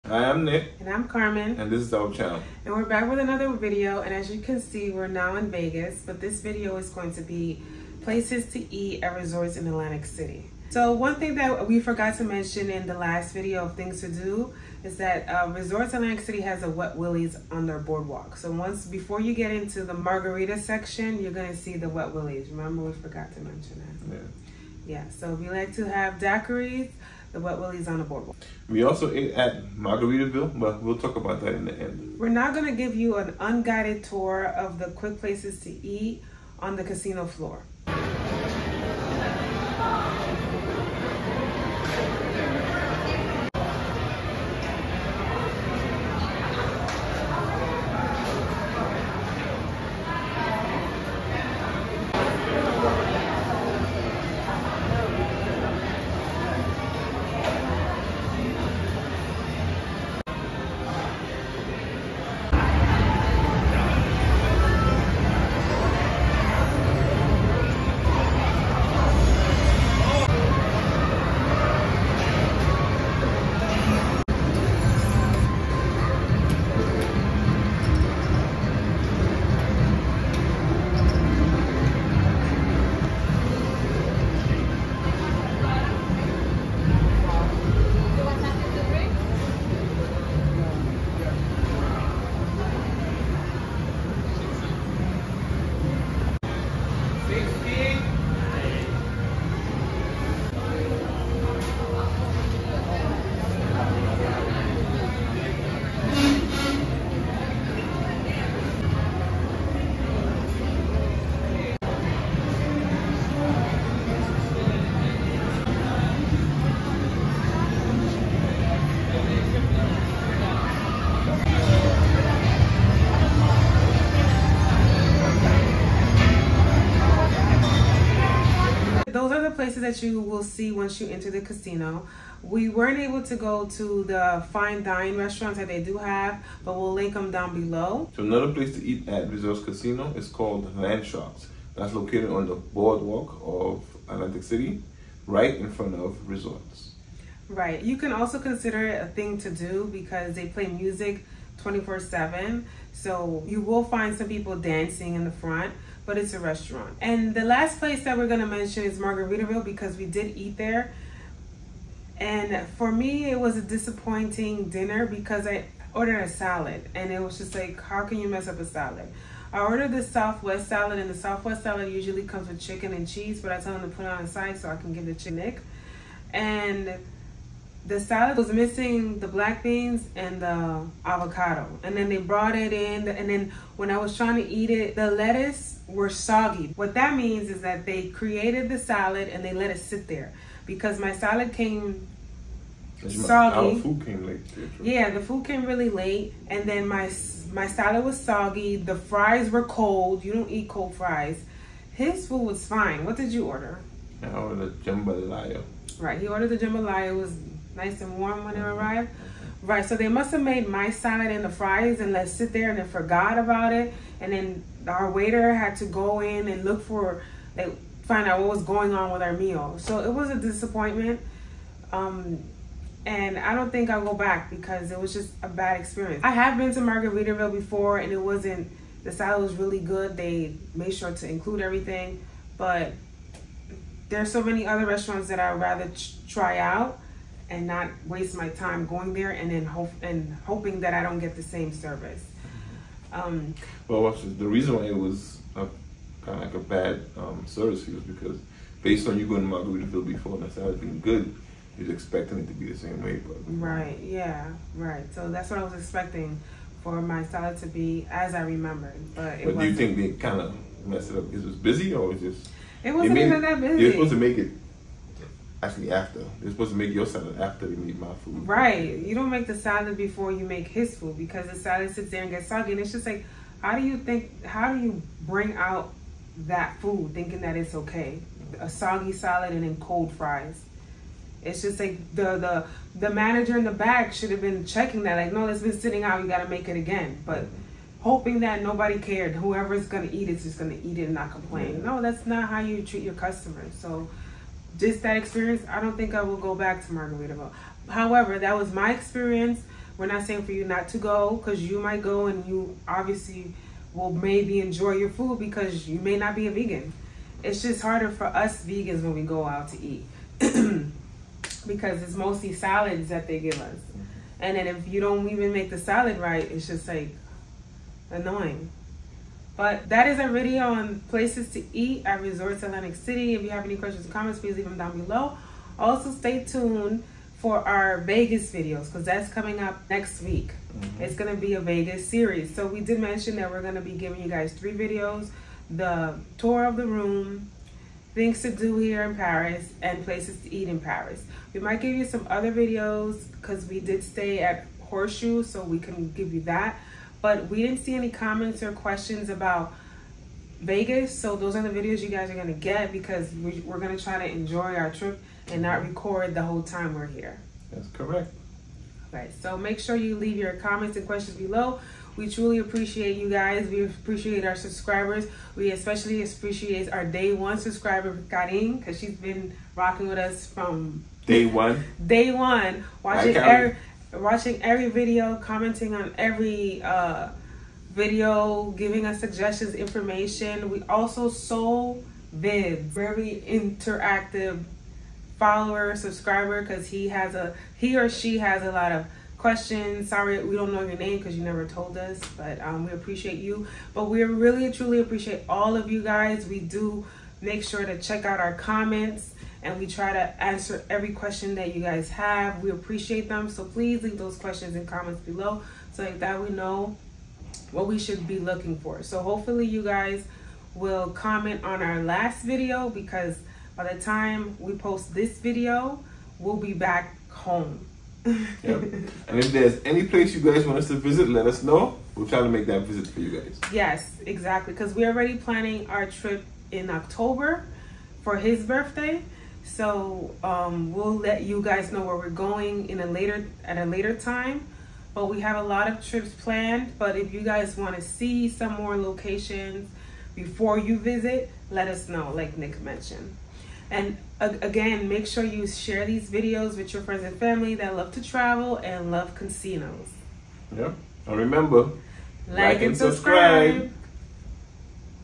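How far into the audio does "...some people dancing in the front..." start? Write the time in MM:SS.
02:34.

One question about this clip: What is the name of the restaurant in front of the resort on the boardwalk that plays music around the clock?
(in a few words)
Land Sharks.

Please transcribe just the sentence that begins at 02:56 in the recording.
And the salad was missing the black beans and the avocado.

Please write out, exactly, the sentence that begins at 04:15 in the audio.
So that's what I was expecting for my salad to be as I remembered, but it.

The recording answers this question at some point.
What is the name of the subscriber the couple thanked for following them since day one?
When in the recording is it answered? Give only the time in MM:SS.
06:08.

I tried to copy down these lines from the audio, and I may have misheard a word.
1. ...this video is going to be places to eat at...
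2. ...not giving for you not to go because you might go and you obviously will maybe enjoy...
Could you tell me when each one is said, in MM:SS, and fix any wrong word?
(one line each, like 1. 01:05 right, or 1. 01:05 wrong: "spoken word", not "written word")
1. 00:06 right
2. 05:00 wrong: "saying", not "giving".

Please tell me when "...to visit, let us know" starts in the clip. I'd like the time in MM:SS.
07:00.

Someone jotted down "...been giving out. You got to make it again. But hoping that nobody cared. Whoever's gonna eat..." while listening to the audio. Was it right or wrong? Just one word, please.
wrong.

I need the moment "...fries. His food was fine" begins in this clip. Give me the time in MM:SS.
03:20.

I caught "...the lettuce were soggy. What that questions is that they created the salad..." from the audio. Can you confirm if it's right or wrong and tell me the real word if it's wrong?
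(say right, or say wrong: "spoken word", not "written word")
wrong: "means", not "questions".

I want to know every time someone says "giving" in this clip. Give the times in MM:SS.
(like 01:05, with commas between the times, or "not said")
05:34, 06:18.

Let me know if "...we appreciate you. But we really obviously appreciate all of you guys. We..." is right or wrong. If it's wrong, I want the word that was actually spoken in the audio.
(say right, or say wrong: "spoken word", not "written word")
wrong: "truly", not "obviously".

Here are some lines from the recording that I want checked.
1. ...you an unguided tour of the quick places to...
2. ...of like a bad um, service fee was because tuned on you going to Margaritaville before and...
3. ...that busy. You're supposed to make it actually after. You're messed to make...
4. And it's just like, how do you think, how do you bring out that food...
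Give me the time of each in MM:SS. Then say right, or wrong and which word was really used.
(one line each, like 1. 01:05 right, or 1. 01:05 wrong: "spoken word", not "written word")
1. 00:32 right
2. 04:06 wrong: "based", not "tuned"
3. 04:23 wrong: "supposed", not "messed"
4. 04:32 right.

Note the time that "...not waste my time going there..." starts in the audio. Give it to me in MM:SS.
03:57.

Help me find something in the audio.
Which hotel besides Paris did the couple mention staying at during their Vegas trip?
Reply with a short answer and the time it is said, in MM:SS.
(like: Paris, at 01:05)
Horseshoe, at 05:44.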